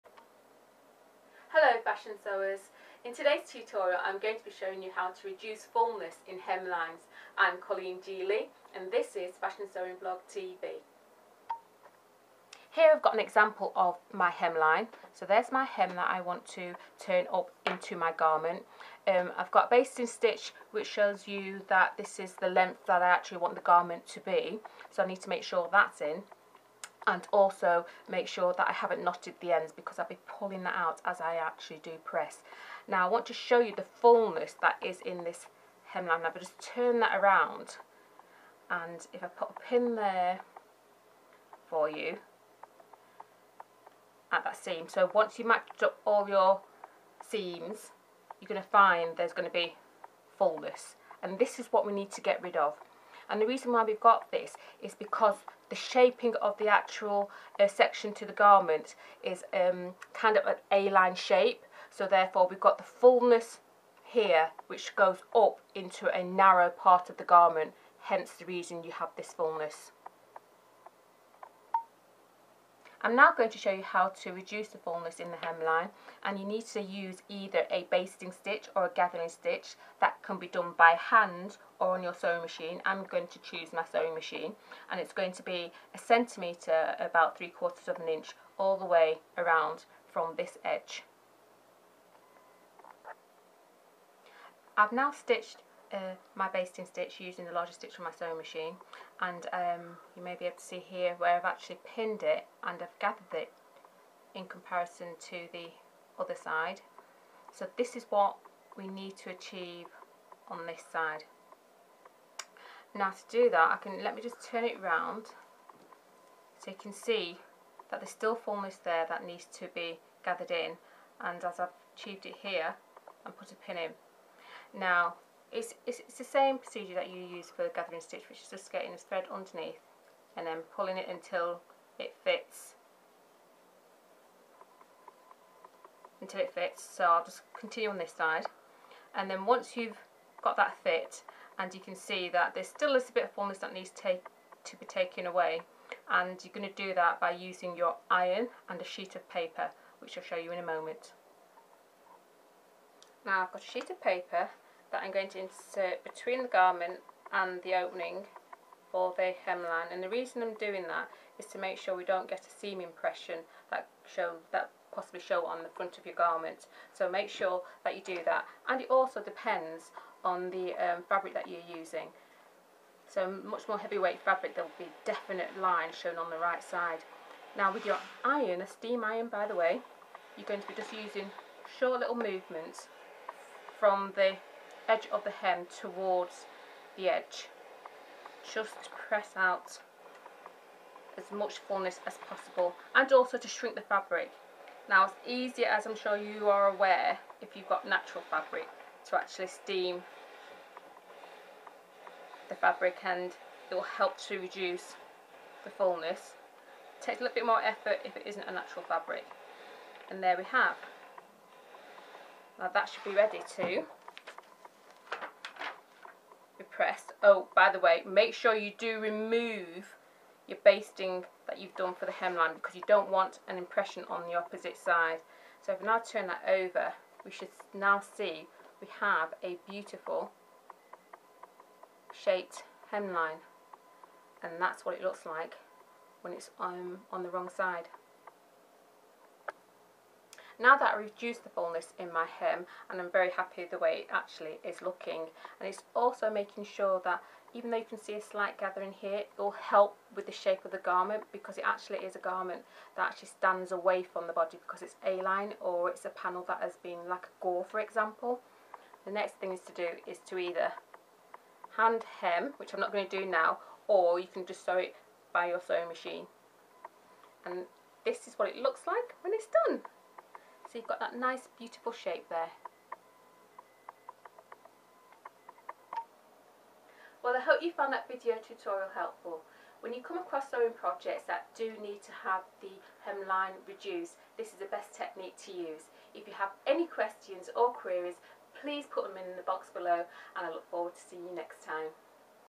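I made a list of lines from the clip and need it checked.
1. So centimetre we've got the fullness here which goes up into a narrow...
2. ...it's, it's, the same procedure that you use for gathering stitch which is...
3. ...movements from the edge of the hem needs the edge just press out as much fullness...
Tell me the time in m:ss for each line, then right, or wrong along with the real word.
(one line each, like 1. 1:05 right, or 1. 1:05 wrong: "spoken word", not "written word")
1. 1:01 wrong: "therefore", not "centimetre"
2. 2:05 right
3. 3:02 wrong: "towards", not "needs".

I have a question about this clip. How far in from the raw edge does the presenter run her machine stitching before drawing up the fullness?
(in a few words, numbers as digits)
1 centimetre.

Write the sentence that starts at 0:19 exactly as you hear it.
Um, I've got basting stitch which shows you that this is the length that I actually want the garment to be.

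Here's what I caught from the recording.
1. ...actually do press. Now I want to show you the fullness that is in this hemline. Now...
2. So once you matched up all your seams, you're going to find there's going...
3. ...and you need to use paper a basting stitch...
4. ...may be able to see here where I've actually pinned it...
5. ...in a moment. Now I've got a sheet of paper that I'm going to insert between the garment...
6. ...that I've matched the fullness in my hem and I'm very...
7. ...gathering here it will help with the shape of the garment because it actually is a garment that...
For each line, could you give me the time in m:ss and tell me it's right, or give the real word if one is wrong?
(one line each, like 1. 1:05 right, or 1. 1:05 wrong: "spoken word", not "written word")
1. 0:31 right
2. 0:44 right
3. 1:16 wrong: "either", not "paper"
4. 1:40 right
5. 2:30 right
6. 4:00 wrong: "reduced", not "matched"
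7. 4:08 right.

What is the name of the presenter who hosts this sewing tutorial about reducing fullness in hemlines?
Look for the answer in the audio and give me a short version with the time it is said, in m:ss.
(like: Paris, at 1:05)
Colleen G Lea, at 0:07.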